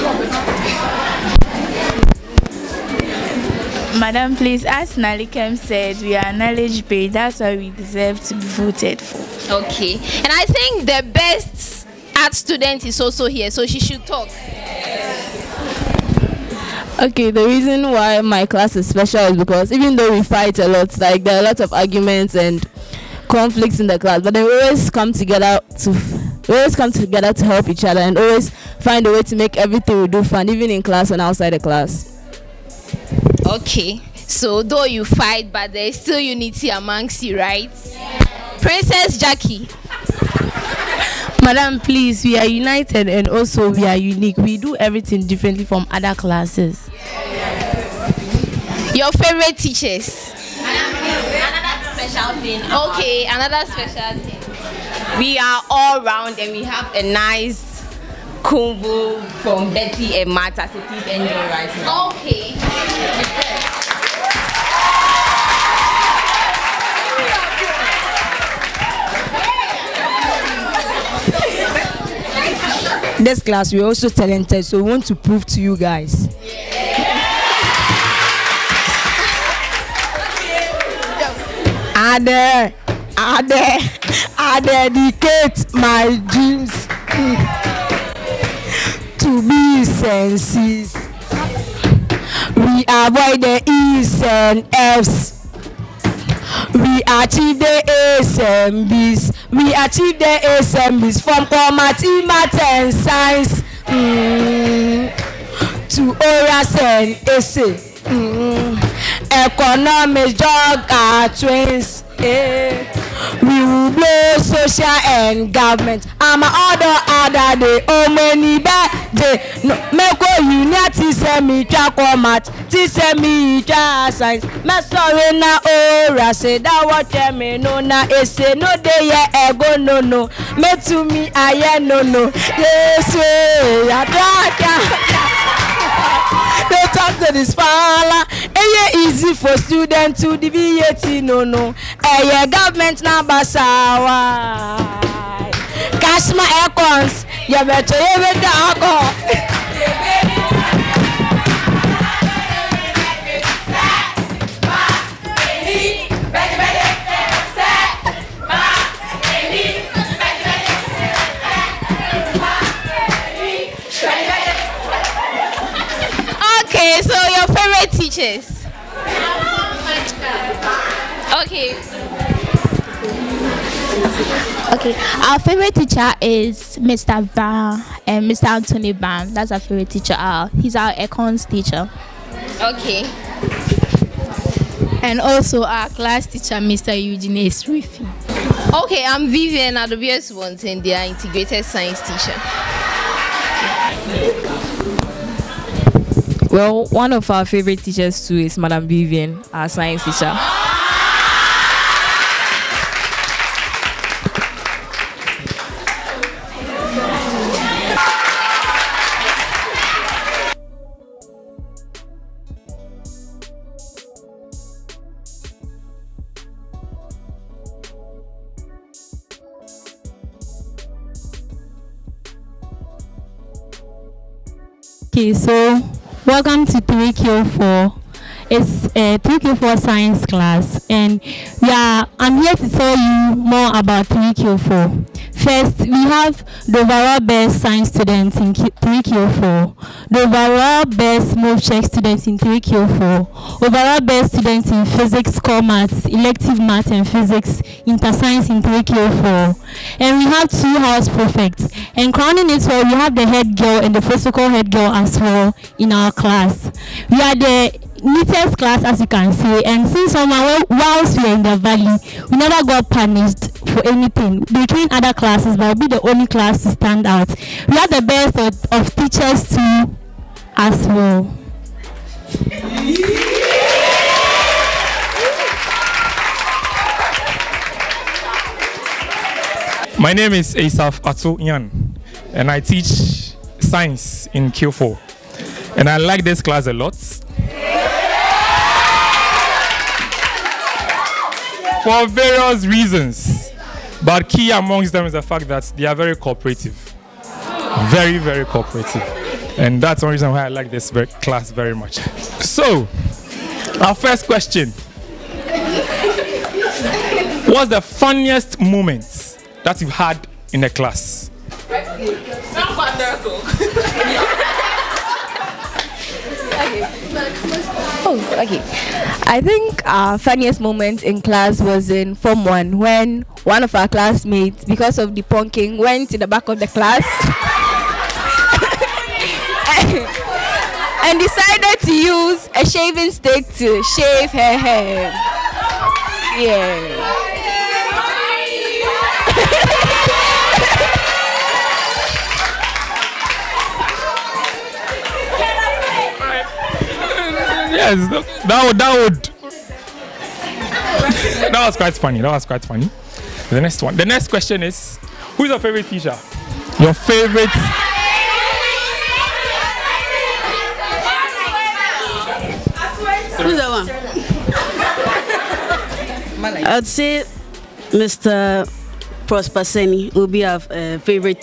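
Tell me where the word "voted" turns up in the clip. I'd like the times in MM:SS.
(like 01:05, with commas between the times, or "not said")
00:08.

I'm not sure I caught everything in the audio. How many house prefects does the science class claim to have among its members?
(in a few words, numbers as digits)
2.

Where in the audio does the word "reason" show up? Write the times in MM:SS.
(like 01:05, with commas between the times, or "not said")
00:17, 04:52, 05:00.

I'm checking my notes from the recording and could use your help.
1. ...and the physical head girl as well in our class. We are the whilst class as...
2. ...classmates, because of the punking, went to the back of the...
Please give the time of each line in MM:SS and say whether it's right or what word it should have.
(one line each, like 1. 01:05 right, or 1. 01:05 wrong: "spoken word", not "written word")
1. 04:13 wrong: "neatest", not "whilst"
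2. 05:23 right.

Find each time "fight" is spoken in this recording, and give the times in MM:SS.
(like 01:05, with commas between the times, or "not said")
00:20, 00:35.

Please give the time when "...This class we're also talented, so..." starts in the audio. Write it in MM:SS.
01:13.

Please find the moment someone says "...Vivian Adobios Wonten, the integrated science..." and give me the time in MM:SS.
03:09.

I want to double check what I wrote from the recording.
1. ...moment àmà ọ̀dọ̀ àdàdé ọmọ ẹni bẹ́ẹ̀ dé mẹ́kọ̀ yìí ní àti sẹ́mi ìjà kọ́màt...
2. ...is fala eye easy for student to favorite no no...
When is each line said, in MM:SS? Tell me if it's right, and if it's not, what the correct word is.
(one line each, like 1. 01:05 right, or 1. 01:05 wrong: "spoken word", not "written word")
1. 01:55 wrong: "government", not "moment"
2. 02:17 wrong: "deviate", not "favorite".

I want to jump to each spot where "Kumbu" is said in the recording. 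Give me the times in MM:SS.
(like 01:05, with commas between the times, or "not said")
00:58.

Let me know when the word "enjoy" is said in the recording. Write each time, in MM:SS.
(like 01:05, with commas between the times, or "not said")
01:01.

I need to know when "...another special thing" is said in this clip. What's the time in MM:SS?
00:53.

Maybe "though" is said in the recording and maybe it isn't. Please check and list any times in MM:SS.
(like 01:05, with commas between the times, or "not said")
00:19, 00:34.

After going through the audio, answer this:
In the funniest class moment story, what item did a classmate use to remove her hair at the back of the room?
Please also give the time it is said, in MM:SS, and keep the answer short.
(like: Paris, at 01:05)
Shaving stick, at 05:32.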